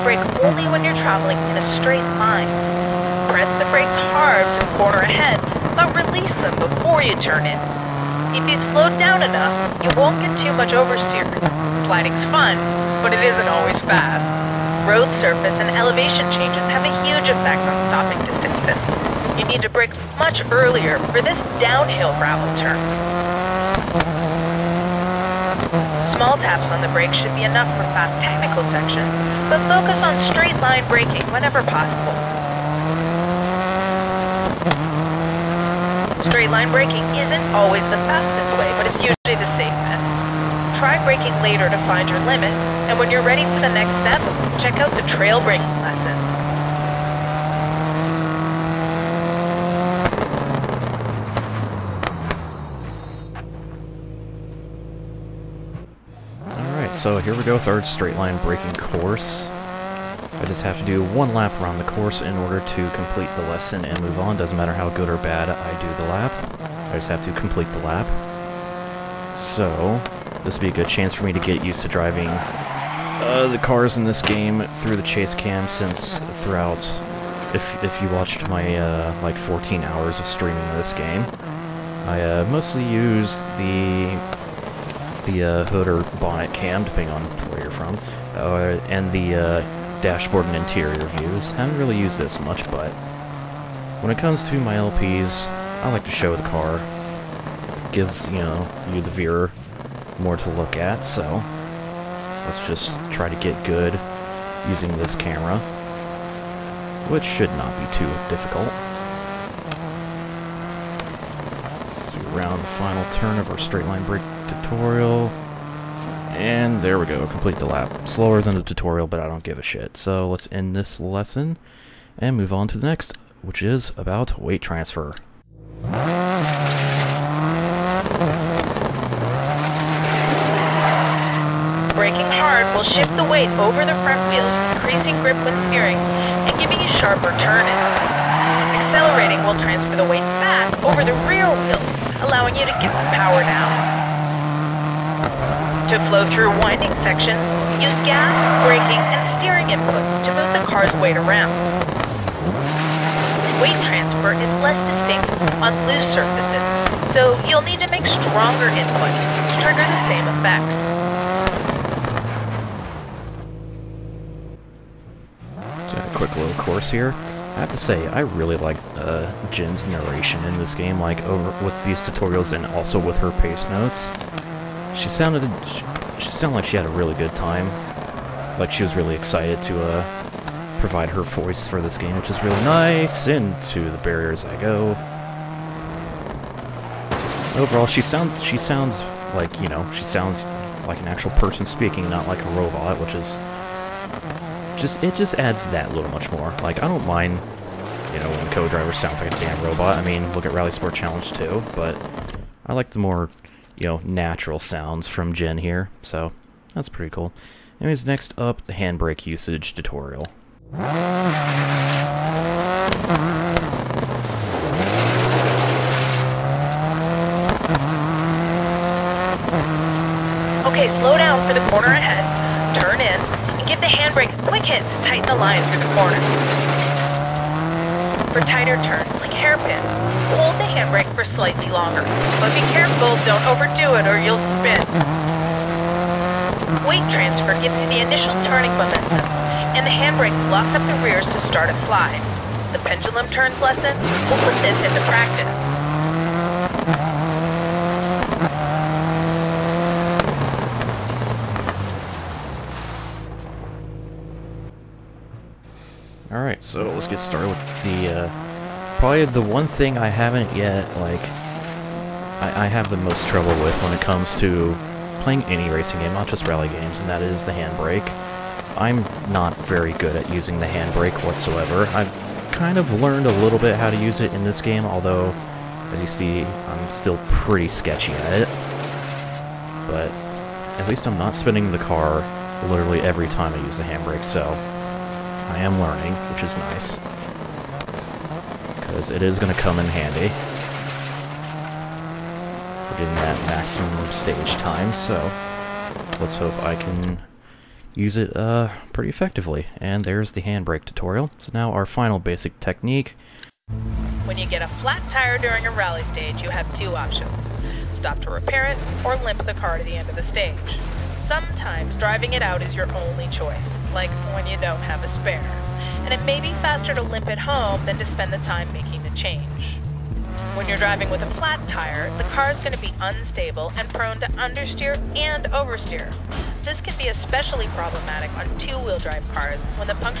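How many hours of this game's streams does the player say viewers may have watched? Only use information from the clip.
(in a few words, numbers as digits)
14.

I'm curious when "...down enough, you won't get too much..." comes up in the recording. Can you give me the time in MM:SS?
00:08.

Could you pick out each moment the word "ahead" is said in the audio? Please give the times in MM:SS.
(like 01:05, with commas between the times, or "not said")
00:04, 03:41.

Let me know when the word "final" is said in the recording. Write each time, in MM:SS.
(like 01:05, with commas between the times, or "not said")
01:52, 05:01.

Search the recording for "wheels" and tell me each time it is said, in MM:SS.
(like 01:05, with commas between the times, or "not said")
02:14, 02:21, 05:28.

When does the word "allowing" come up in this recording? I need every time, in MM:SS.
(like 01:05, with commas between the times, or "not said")
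02:22.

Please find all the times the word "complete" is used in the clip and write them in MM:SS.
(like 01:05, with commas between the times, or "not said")
01:02, 01:07, 01:57.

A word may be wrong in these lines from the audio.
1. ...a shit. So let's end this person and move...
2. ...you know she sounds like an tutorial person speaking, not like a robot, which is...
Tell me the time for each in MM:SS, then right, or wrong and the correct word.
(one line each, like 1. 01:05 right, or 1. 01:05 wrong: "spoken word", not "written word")
1. 01:59 wrong: "lesson", not "person"
2. 03:09 wrong: "actual", not "tutorial".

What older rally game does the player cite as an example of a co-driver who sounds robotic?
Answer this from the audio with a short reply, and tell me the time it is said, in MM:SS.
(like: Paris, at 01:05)
RalliSport Challenge, at 03:20.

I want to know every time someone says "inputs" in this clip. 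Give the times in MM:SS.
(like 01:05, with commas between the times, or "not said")
02:29, 02:38.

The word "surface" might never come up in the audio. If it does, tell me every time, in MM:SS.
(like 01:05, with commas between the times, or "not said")
00:15, 02:36.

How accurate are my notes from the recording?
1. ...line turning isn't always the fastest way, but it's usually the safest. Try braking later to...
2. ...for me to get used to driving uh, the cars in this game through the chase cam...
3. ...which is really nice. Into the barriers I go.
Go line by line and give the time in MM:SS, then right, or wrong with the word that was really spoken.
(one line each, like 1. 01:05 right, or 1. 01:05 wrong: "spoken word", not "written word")
1. 00:36 wrong: "braking", not "turning"
2. 01:11 right
3. 03:02 right.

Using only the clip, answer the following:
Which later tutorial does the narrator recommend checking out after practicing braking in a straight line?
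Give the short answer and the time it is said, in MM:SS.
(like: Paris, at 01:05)
Trail braking lesson, at 00:45.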